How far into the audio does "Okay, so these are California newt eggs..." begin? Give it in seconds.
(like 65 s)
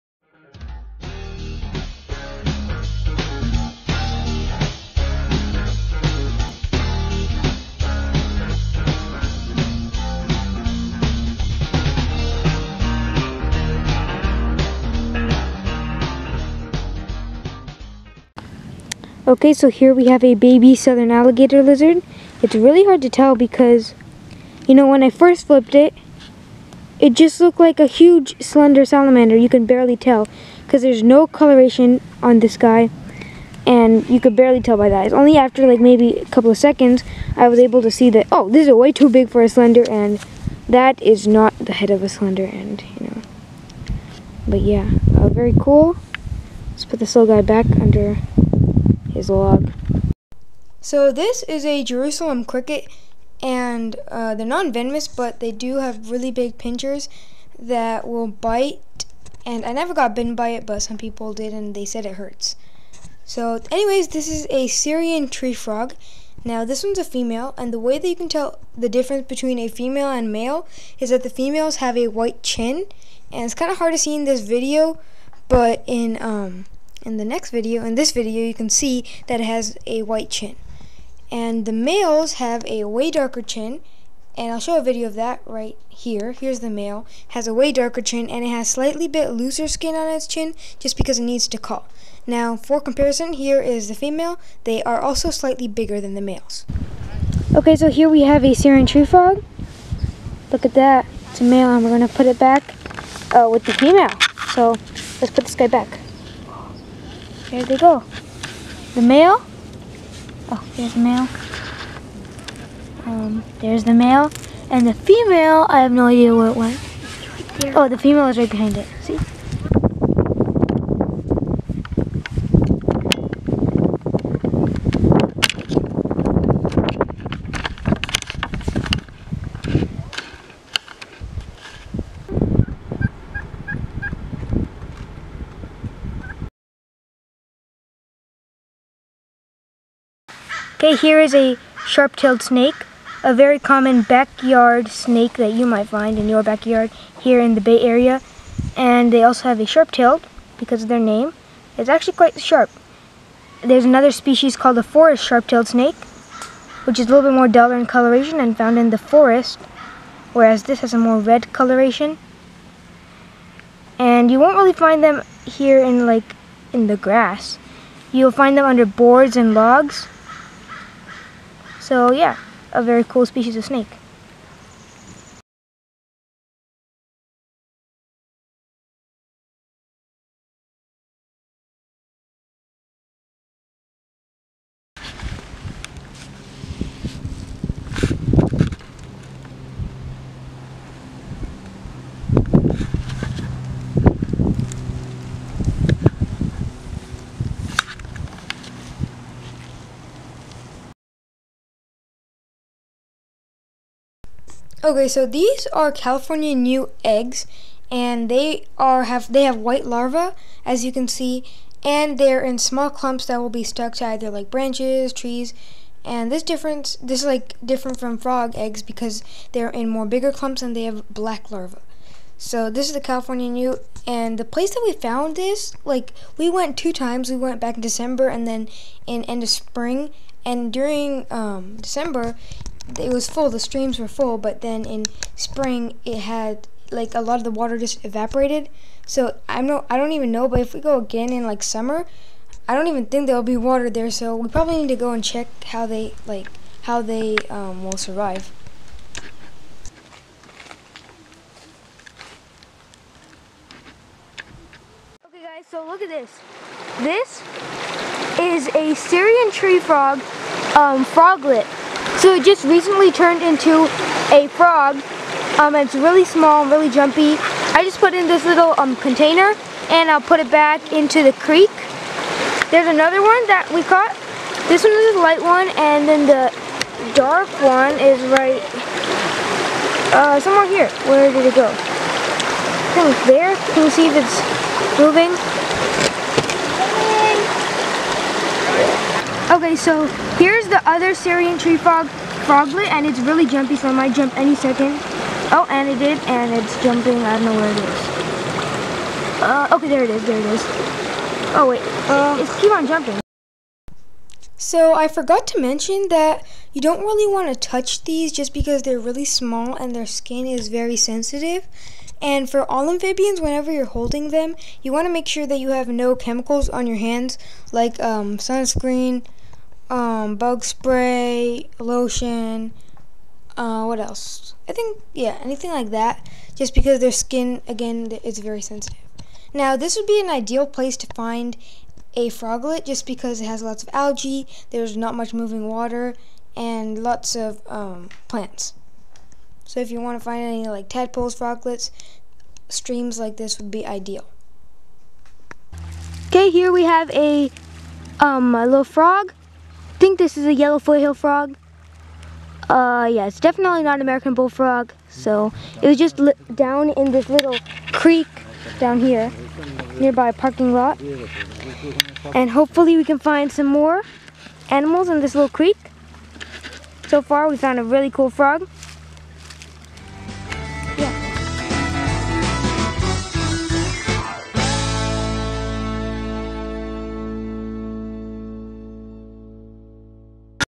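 204 s.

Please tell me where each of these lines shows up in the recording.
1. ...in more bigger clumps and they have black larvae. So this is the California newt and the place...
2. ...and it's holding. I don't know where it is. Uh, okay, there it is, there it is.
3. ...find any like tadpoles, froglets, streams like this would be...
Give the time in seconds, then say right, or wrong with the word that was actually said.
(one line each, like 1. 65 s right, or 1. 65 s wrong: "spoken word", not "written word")
1. 219 s right
2. 296 s wrong: "jumping", not "holding"
3. 340 s right.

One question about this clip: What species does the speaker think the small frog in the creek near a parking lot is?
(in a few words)
Yellow foothill frog.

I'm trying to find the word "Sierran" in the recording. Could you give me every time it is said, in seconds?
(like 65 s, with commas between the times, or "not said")
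64 s, 98 s, 258 s, 291 s.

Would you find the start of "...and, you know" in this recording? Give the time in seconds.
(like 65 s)
42 s.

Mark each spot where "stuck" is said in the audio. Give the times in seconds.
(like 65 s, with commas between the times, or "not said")
213 s.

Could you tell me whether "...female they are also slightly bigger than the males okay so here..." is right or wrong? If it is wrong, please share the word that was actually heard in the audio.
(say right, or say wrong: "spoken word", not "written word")
right.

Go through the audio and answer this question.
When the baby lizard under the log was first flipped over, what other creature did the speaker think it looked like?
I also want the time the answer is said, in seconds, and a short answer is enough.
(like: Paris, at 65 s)
Slender salamander, at 28 s.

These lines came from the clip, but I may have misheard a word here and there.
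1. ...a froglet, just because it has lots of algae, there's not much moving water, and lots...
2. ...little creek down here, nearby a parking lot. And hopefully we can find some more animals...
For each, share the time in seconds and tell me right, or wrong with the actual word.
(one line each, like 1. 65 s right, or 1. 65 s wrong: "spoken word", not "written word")
1. 332 s right
2. 357 s right.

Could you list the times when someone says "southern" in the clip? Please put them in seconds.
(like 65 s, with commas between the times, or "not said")
20 s.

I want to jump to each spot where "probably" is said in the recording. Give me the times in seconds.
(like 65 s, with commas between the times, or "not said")
244 s.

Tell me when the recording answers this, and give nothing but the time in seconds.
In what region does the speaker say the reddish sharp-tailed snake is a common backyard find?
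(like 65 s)
147 s.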